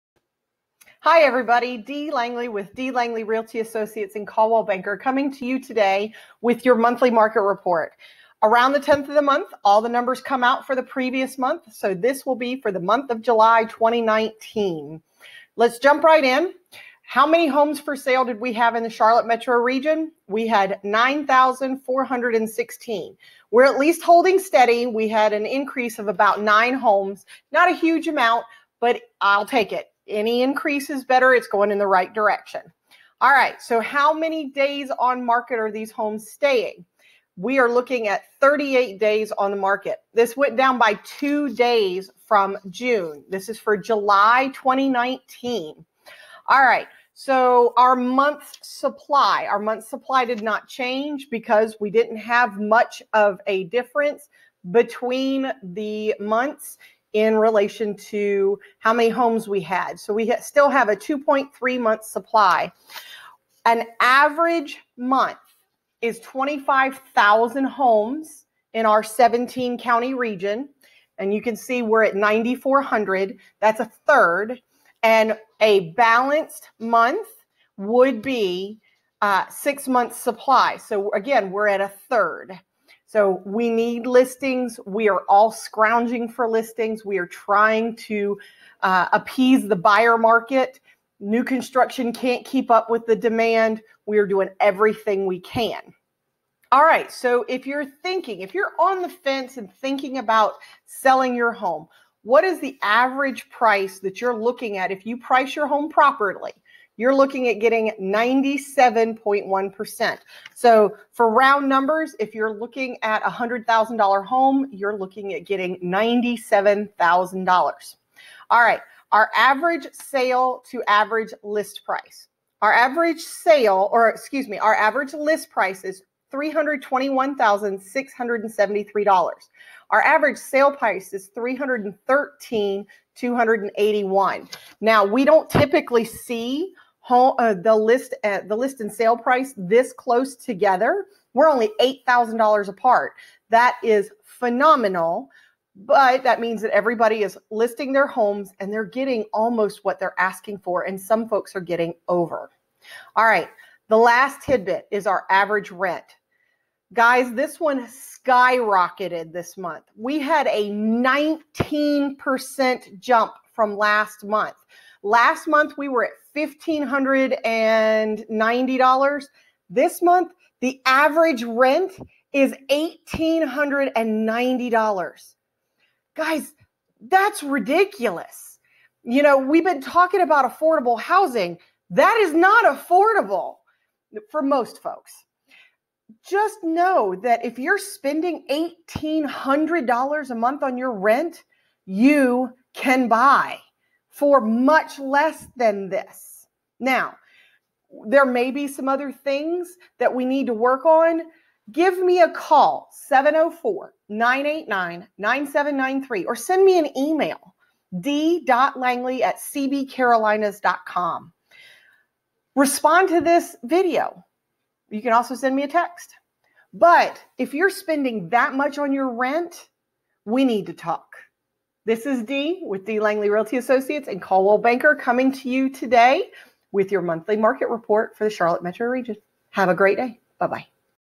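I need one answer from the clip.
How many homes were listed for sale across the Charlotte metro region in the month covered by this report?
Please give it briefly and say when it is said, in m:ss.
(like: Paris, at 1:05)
9,416, at 0:20.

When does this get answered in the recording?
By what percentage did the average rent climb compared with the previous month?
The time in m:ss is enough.
2:40.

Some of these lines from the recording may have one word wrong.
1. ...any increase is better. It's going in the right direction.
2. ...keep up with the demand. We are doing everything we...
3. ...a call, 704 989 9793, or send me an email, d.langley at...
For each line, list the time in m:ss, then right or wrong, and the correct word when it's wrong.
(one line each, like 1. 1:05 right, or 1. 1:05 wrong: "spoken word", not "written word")
1. 0:30 right
2. 1:32 right
3. 3:22 right.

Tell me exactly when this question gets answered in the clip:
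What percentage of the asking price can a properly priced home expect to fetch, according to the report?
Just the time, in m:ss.
1:47.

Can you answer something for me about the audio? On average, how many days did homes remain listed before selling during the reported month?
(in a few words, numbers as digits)
38 days.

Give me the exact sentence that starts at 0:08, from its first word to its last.
Around the 10th of the month, all the numbers come out for the previous month.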